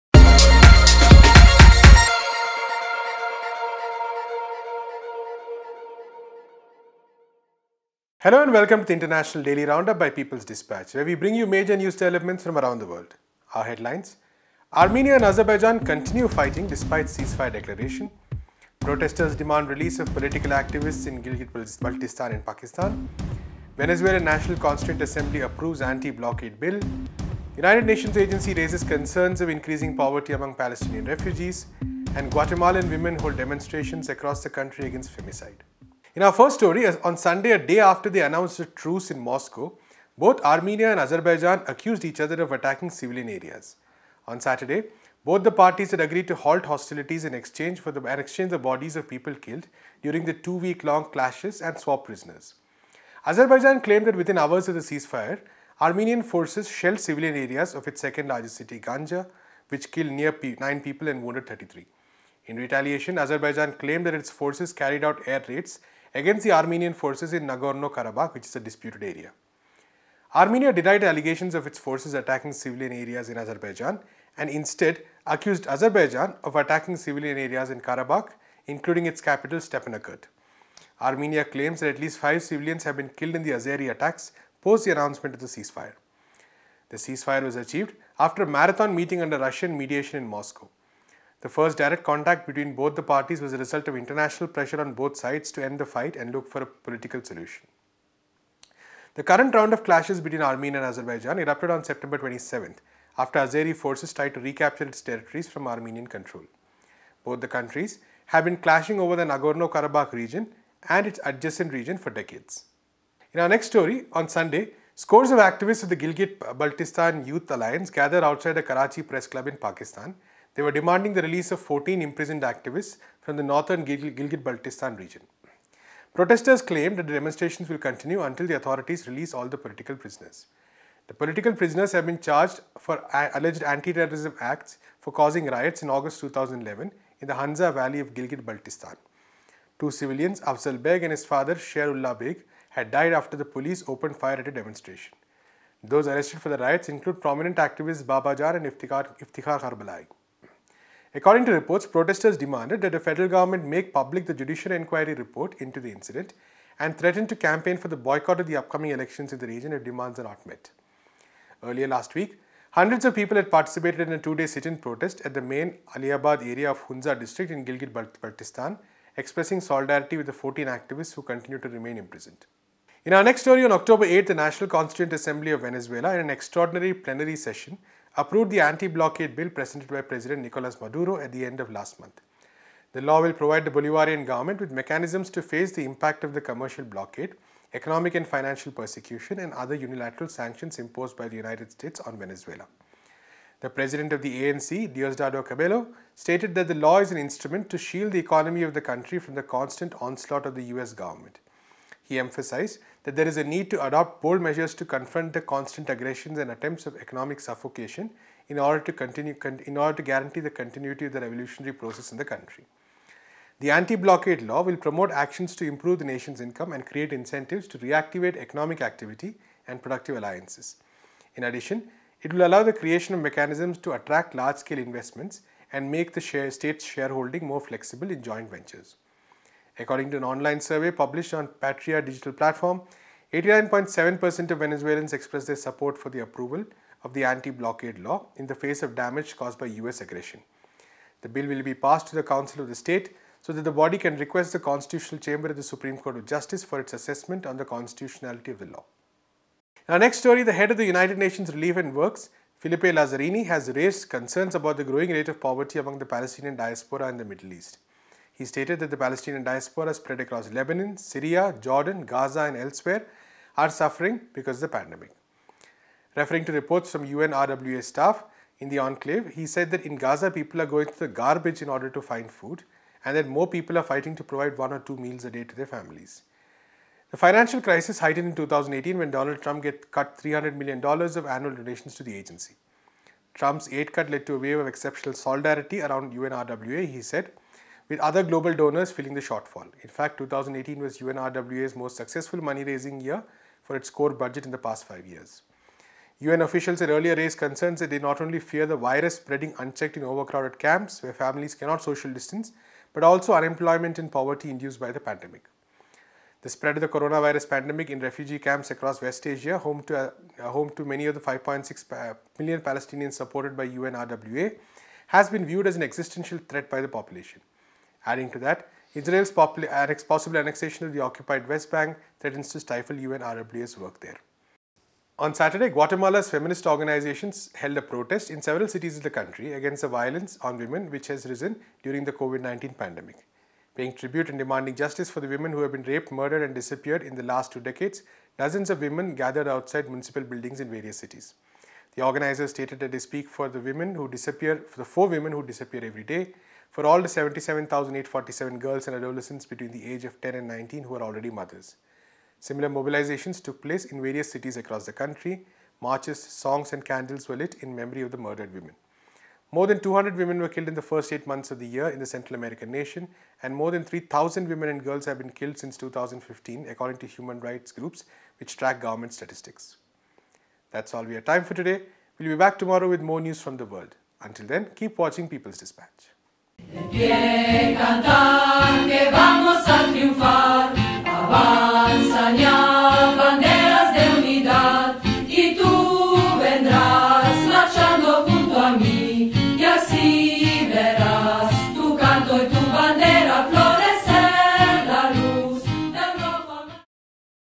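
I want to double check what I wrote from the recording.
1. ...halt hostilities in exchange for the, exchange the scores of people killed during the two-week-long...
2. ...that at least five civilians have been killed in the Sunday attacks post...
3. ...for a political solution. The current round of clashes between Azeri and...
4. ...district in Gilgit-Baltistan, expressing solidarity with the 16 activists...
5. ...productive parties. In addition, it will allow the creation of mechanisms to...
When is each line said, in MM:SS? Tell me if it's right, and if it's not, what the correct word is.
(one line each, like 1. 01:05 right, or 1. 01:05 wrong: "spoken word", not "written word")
1. 00:46 wrong: "bodies", not "scores"
2. 01:21 wrong: "Azeri", not "Sunday"
3. 01:36 wrong: "Armenia", not "Azeri"
4. 02:47 wrong: "14", not "16"
5. 03:39 wrong: "alliances", not "parties".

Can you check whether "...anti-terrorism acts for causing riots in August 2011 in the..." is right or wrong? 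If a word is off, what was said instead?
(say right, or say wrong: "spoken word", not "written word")
right.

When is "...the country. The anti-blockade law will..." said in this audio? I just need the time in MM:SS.
03:32.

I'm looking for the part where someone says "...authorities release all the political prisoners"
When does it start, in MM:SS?
02:08.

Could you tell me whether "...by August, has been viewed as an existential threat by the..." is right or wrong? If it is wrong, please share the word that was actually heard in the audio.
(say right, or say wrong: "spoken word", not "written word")
wrong: "UNRWA", not "August".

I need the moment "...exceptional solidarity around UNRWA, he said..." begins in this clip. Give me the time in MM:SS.
04:44.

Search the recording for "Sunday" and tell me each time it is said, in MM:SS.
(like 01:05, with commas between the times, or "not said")
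00:37, 01:54.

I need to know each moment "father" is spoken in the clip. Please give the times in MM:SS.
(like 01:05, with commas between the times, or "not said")
02:21.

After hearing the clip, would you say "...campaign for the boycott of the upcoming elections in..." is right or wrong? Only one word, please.
right.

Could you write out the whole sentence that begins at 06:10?
That's all we have time for today.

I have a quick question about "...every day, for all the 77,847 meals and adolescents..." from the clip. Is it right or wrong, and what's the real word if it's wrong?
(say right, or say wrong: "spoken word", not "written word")
wrong: "girls", not "meals".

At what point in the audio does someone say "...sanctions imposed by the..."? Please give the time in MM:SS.
03:10.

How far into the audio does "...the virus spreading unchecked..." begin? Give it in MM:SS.
04:58.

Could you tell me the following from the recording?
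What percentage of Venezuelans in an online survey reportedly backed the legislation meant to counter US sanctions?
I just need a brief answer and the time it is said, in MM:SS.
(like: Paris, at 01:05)
89.7%, at 03:53.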